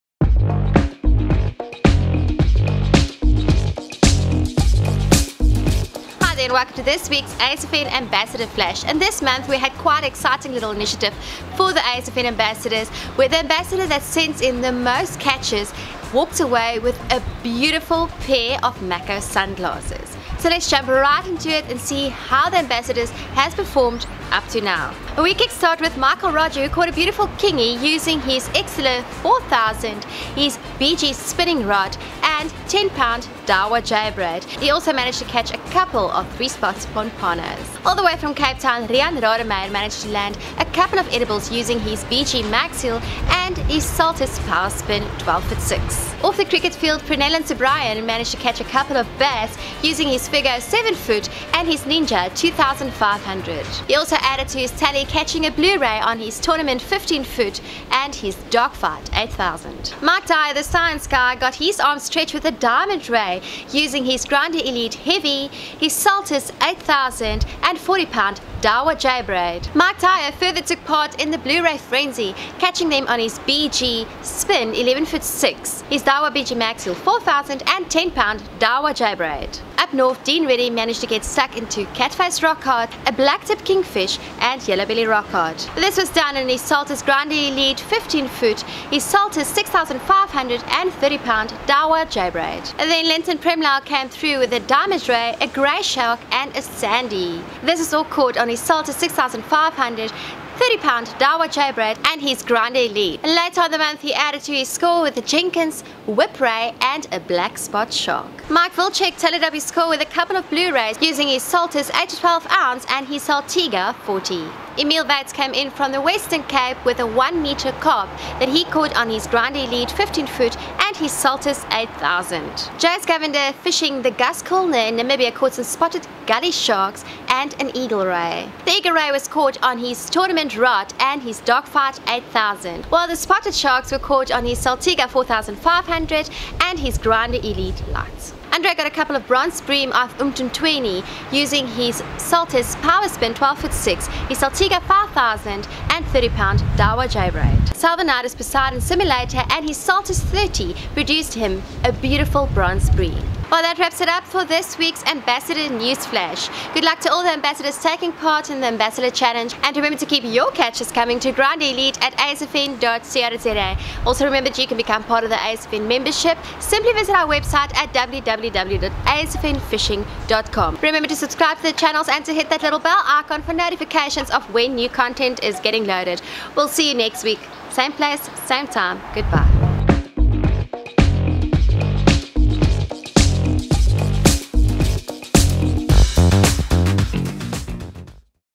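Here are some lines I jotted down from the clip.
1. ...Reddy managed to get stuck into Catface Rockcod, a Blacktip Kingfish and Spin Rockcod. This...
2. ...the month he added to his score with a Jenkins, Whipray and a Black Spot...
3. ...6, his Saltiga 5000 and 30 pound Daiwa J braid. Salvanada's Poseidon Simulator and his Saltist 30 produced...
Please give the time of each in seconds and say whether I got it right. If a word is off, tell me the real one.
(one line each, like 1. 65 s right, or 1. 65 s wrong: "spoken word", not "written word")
1. 80 s wrong: "Yellowbelly", not "Spin"
2. 103 s right
3. 143 s right.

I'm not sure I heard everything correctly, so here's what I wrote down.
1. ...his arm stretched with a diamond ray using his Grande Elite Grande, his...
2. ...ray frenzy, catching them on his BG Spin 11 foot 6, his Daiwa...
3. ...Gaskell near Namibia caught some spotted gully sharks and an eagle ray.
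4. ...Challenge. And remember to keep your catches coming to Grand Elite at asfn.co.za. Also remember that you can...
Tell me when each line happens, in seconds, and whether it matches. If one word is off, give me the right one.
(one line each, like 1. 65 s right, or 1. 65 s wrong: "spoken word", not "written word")
1. 61 s wrong: "Heavy", not "Grande"
2. 71 s right
3. 124 s right
4. 159 s right.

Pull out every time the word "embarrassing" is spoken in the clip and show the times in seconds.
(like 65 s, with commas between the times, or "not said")
not said.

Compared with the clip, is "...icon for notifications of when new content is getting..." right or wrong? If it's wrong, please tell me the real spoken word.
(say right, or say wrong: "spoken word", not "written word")
right.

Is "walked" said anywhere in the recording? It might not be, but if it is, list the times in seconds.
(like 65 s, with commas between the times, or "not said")
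16 s.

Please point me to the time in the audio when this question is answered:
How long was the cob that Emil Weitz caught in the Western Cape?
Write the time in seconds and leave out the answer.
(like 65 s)
117 s.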